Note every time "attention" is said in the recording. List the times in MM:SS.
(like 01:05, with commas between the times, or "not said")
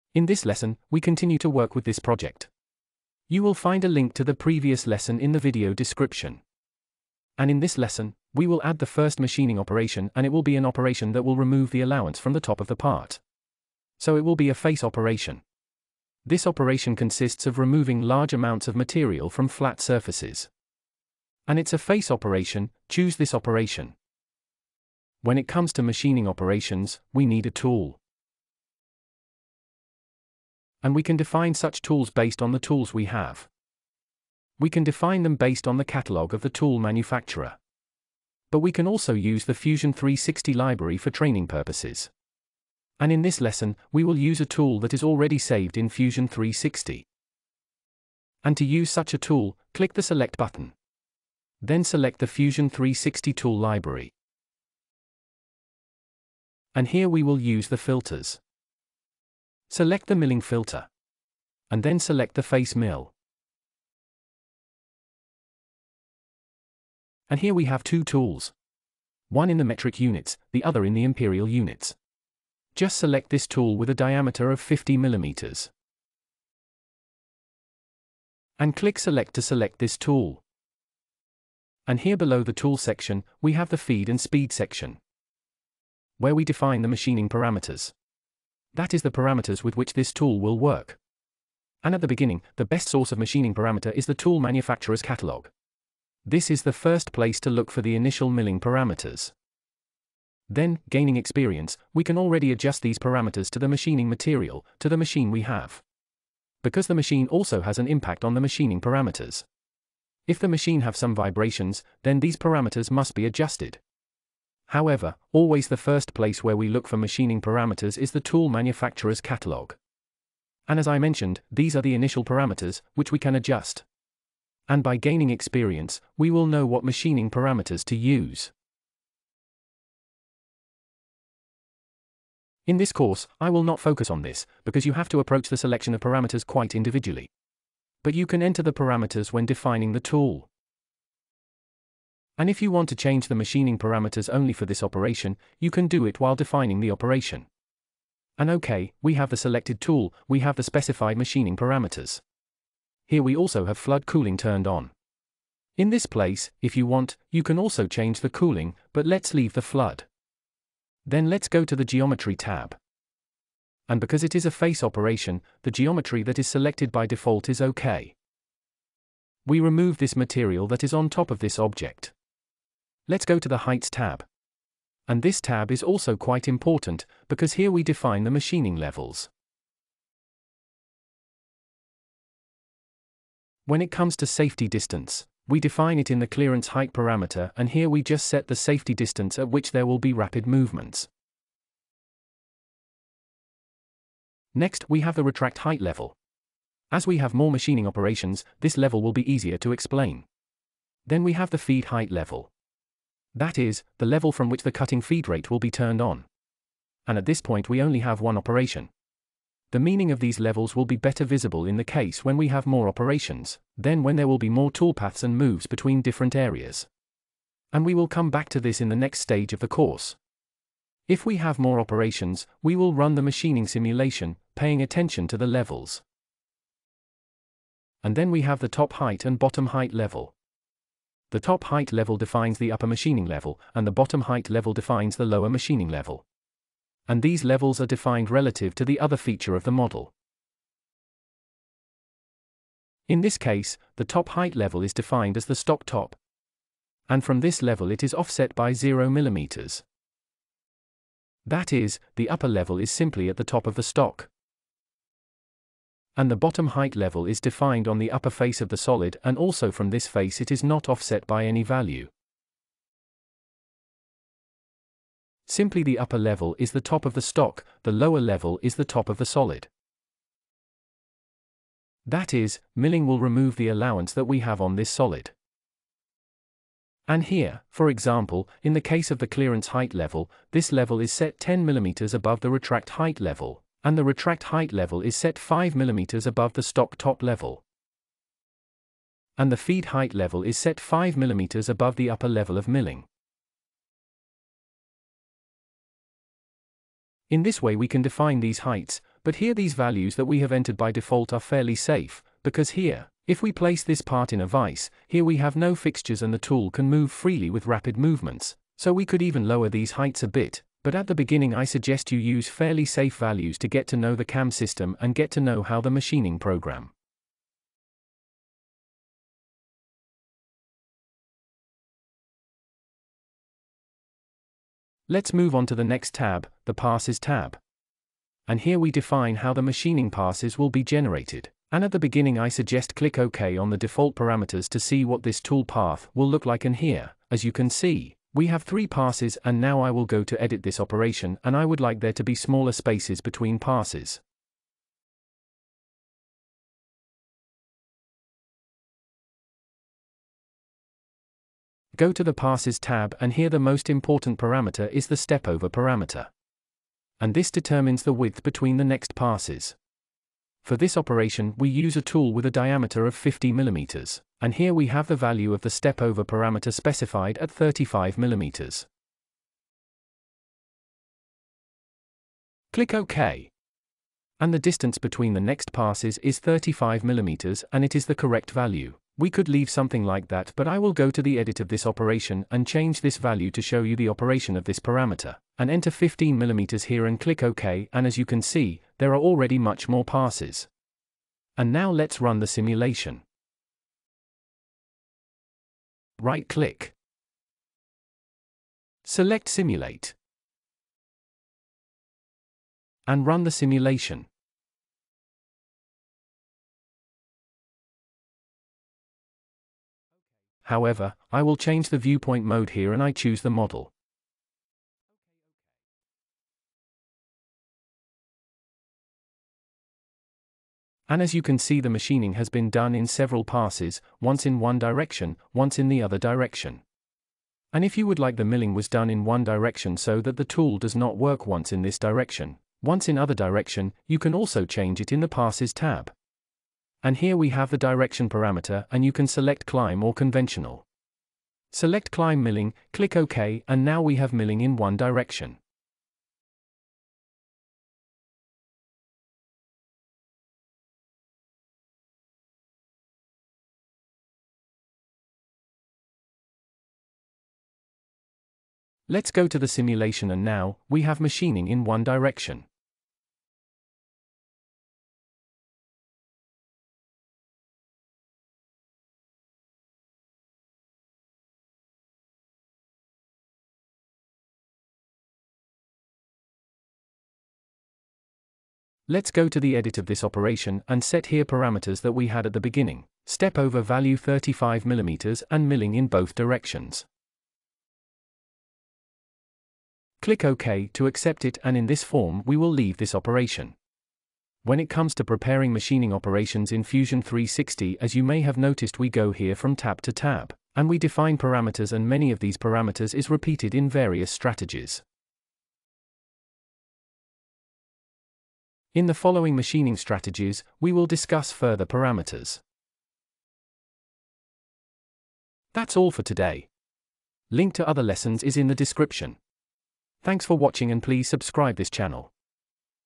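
03:44.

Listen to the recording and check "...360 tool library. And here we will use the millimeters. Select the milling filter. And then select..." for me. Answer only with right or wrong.
wrong.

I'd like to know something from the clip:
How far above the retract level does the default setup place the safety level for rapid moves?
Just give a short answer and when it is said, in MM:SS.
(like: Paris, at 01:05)
10 mm, at 04:41.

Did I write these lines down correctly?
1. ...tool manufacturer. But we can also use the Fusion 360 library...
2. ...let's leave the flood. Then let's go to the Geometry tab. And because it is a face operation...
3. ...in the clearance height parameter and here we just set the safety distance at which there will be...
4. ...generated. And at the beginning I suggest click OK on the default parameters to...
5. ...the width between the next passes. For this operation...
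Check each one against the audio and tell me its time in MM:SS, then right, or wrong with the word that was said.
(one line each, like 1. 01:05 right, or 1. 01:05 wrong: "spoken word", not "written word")
1. 00:36 right
2. 02:39 right
3. 03:06 right
4. 05:30 right
5. 05:58 right.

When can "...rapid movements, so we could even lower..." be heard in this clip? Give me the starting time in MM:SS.
05:07.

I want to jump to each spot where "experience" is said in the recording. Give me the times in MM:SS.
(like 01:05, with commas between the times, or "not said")
01:41, 02:05.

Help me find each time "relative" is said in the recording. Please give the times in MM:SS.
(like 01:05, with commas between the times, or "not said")
03:58.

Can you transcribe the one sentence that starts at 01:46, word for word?
Because the machine also has an impact on the machining parameters.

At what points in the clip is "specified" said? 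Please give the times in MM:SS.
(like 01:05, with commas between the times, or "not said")
02:30, 06:06.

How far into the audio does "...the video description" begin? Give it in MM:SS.
00:05.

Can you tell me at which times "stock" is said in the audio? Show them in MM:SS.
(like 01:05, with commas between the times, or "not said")
04:05, 04:13, 04:27, 04:46.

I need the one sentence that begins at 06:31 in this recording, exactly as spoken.
And now let's run the simulation.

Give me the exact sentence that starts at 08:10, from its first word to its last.
Click OK to accept it and in this form we will leave this operation.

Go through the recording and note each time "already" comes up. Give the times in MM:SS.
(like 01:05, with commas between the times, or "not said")
00:45, 01:42, 06:29.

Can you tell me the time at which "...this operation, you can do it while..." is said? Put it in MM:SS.
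02:24.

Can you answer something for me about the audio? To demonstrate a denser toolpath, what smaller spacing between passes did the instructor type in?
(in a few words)
15 mm.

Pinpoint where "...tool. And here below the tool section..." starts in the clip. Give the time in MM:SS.
01:19.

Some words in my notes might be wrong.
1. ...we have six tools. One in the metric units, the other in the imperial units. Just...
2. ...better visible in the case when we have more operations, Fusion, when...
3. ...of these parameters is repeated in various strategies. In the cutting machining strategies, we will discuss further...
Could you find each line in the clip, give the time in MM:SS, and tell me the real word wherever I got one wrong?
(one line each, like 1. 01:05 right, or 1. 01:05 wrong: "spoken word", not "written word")
1. 01:07 wrong: "two", not "six"
2. 03:30 wrong: "Then", not "Fusion"
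3. 08:22 wrong: "following", not "cutting".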